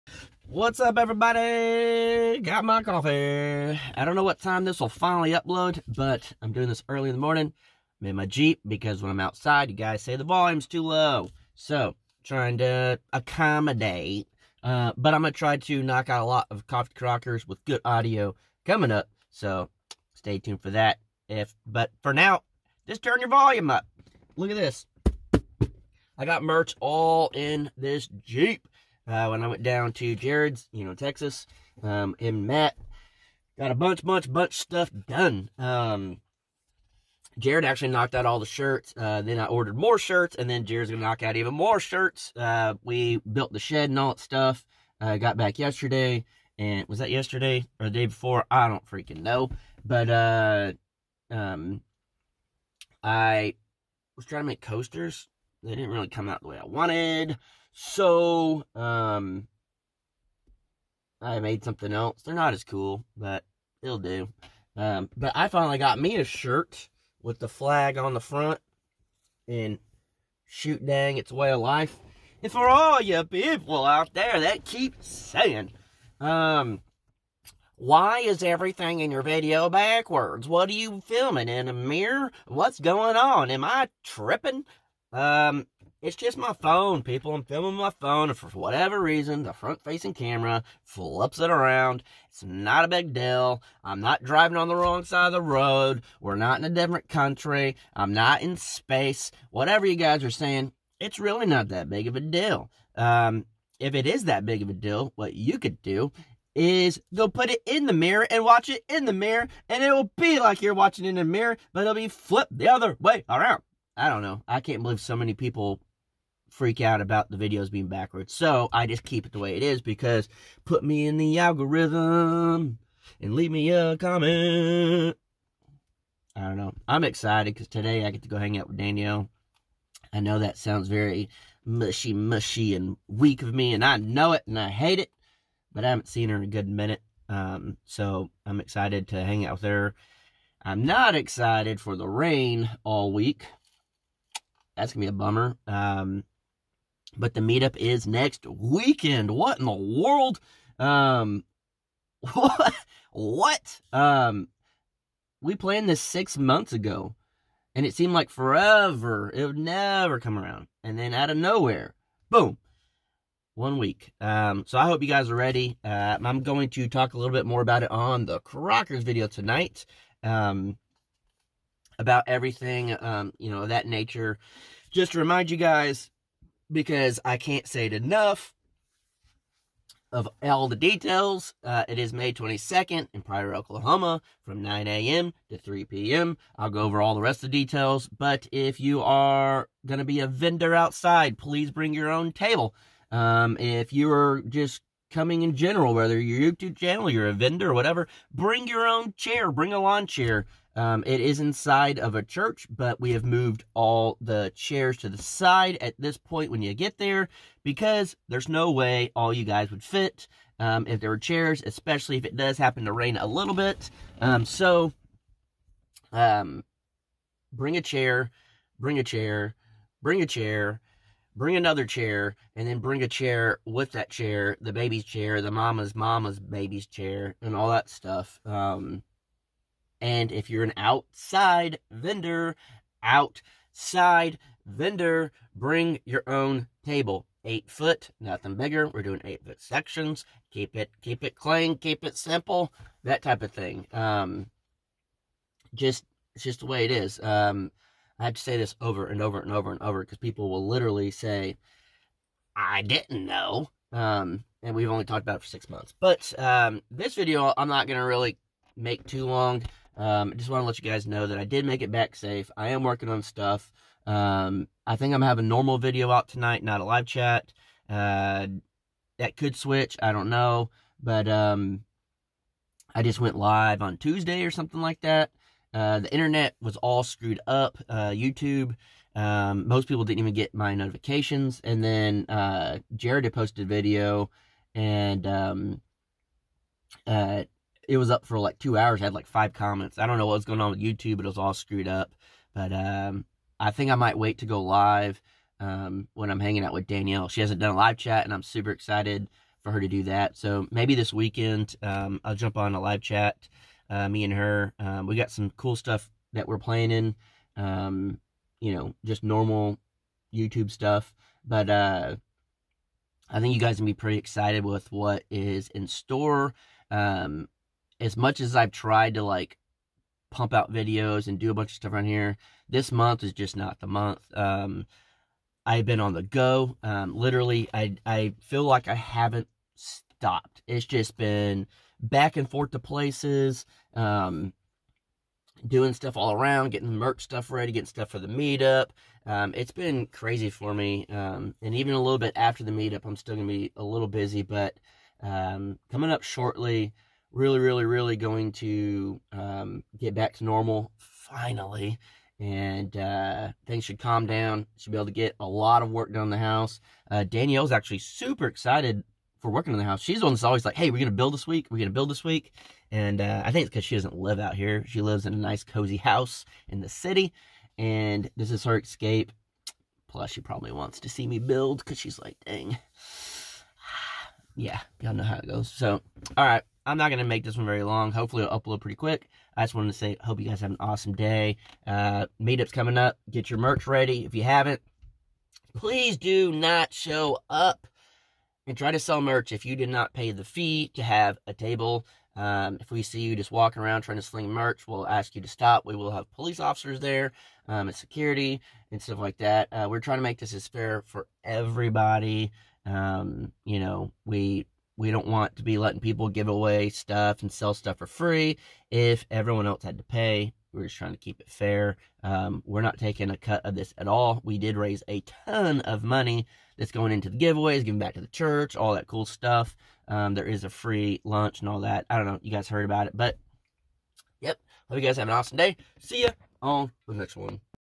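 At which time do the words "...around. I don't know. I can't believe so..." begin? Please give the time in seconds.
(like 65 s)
113 s.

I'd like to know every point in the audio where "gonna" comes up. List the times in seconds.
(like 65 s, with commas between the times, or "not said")
40 s, 257 s.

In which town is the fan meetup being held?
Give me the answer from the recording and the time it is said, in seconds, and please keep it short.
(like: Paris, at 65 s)
Pryor, Oklahoma, at 183 s.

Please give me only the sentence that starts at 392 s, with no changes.
Um, if we see you just walking around trying to sling merch, we'll ask you to stop.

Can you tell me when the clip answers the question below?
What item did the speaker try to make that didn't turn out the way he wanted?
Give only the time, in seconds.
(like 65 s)
54 s.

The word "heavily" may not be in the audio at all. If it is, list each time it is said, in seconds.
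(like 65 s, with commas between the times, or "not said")
not said.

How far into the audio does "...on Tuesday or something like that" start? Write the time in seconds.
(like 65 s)
273 s.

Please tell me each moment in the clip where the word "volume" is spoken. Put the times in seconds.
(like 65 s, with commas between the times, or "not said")
10 s, 23 s.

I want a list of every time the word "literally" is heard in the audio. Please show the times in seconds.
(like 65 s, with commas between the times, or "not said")
250 s, 327 s.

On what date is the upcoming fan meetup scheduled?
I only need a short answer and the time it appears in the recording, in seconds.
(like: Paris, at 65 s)
May 22nd, at 182 s.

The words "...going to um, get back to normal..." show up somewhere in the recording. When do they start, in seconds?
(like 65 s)
348 s.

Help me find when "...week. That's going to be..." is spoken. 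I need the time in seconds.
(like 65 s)
143 s.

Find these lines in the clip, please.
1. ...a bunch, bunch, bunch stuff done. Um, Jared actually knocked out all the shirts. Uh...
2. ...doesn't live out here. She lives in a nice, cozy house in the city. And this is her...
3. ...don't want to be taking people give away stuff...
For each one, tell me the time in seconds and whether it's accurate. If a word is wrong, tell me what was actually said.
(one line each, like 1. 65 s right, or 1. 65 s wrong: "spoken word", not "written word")
1. 33 s right
2. 363 s right
3. 405 s wrong: "letting", not "taking".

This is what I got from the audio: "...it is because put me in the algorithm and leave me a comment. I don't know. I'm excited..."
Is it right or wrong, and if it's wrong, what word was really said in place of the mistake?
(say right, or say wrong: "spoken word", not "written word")
right.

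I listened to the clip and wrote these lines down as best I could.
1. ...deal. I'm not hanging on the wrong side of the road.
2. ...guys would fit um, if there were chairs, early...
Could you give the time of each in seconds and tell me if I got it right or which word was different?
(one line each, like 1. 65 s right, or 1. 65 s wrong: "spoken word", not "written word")
1. 93 s wrong: "driving", not "hanging"
2. 209 s wrong: "especially", not "early".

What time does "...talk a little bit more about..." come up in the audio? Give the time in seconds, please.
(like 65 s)
166 s.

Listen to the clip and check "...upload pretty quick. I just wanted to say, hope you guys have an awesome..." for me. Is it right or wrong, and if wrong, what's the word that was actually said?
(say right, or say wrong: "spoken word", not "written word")
right.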